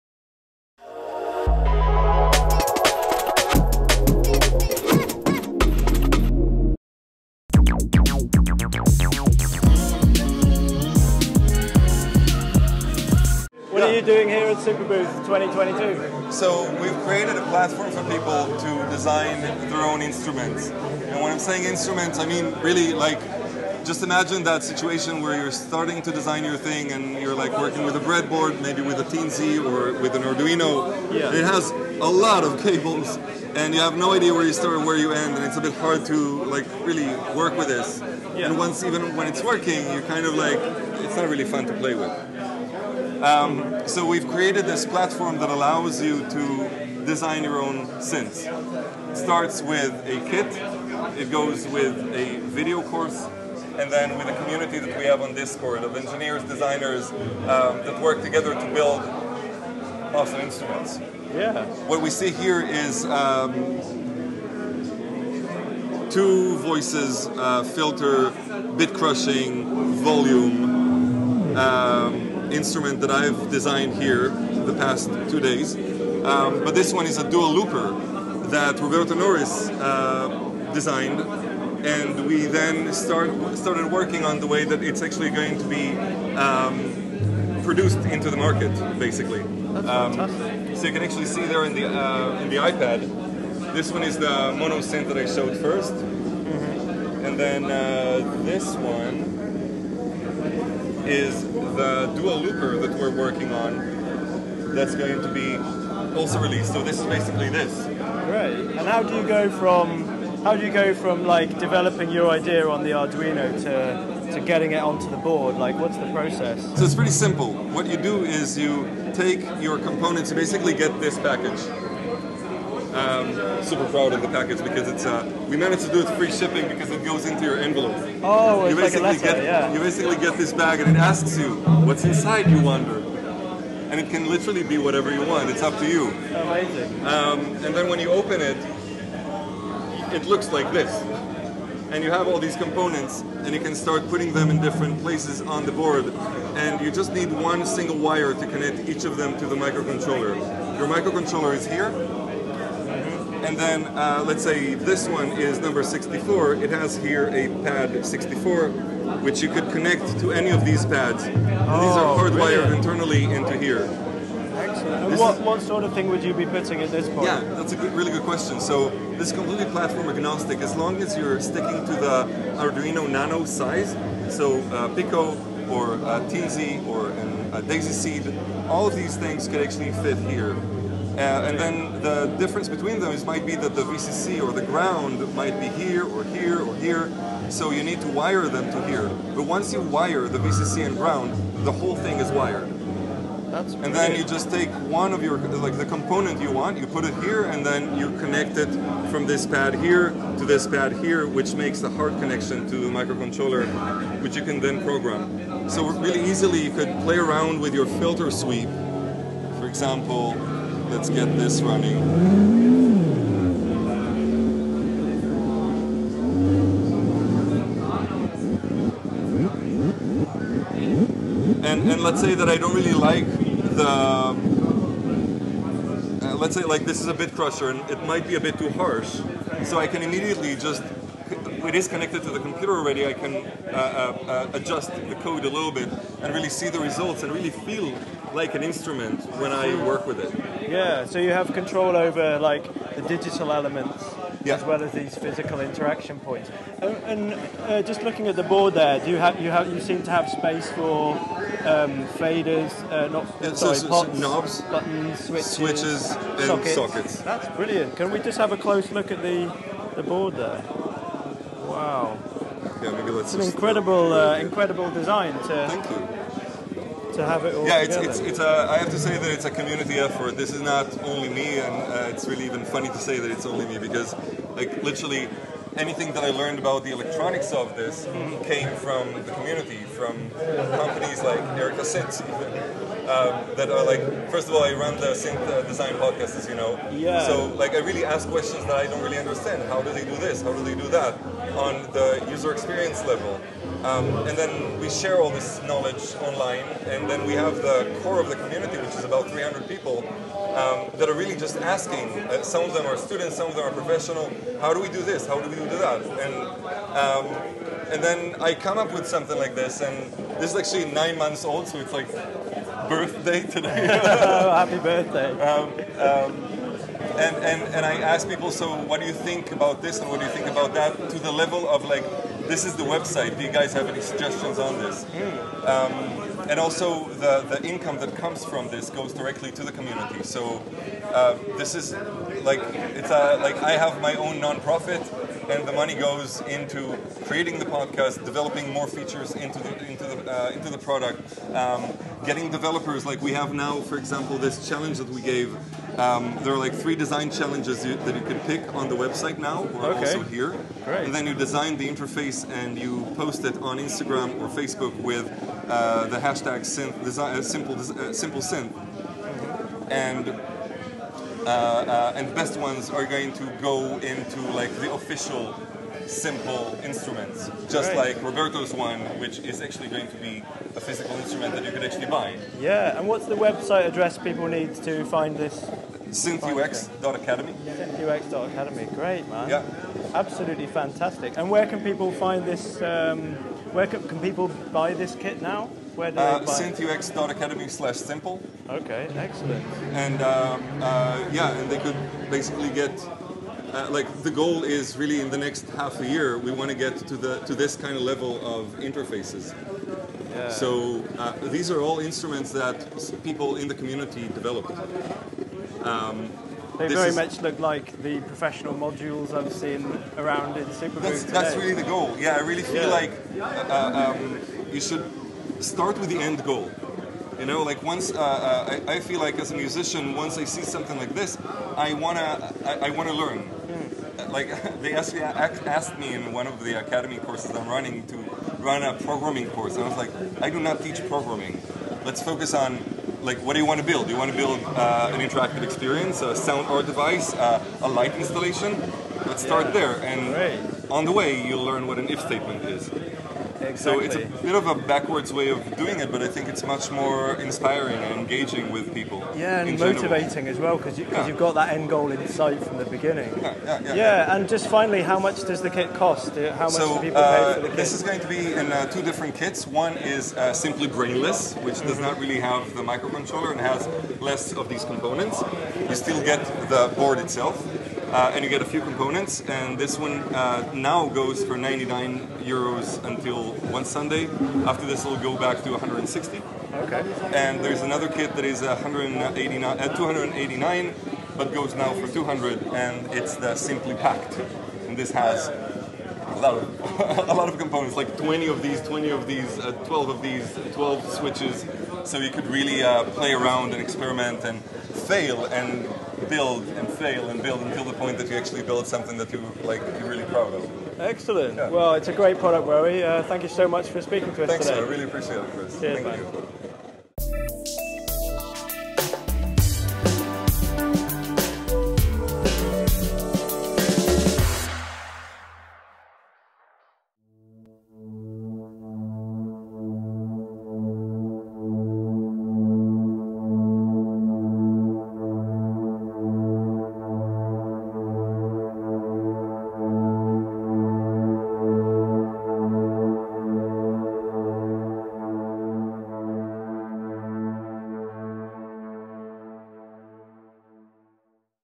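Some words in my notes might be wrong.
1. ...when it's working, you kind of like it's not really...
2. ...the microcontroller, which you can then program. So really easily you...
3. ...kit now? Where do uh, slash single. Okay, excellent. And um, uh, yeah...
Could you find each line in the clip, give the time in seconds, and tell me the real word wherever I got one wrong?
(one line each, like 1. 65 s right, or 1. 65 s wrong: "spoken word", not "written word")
1. 39 s right
2. 202 s right
3. 385 s wrong: "simple", not "single".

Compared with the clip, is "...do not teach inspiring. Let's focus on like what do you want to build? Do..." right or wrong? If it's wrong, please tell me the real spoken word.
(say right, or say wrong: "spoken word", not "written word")
wrong: "programming", not "inspiring".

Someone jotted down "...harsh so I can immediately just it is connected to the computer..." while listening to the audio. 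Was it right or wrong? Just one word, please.
right.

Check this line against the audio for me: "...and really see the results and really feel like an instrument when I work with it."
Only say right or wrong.
right.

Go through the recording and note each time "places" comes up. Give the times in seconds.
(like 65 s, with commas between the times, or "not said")
145 s.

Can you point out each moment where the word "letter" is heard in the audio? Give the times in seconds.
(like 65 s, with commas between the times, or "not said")
129 s.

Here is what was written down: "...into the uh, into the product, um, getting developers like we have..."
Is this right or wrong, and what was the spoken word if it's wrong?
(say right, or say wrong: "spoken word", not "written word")
right.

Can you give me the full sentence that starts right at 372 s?
Yeah, and what's the website address people need to find this?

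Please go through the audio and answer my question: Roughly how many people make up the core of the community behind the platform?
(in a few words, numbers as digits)
300.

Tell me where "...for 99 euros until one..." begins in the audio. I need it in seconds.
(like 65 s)
471 s.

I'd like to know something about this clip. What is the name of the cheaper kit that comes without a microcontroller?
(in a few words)
Simply Brainless.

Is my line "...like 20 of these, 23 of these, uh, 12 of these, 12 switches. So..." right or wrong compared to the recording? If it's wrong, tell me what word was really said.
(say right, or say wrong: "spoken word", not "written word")
wrong: "20", not "23".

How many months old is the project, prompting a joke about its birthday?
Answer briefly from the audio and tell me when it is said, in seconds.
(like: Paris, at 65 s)
9, at 310 s.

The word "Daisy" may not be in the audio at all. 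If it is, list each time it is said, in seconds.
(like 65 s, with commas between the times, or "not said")
177 s.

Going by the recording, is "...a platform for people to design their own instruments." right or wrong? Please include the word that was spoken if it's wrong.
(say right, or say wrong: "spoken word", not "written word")
right.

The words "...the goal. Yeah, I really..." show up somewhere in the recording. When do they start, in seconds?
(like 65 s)
411 s.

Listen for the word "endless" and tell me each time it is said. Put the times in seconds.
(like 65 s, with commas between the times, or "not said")
not said.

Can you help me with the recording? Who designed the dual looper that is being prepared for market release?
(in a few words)
Roberto Norris.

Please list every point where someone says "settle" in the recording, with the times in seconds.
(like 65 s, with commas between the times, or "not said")
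not said.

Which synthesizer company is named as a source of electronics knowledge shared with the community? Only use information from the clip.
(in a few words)
Erica Synths.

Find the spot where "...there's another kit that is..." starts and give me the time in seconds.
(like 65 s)
477 s.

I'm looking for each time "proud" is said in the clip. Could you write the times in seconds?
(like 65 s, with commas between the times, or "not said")
123 s, 500 s.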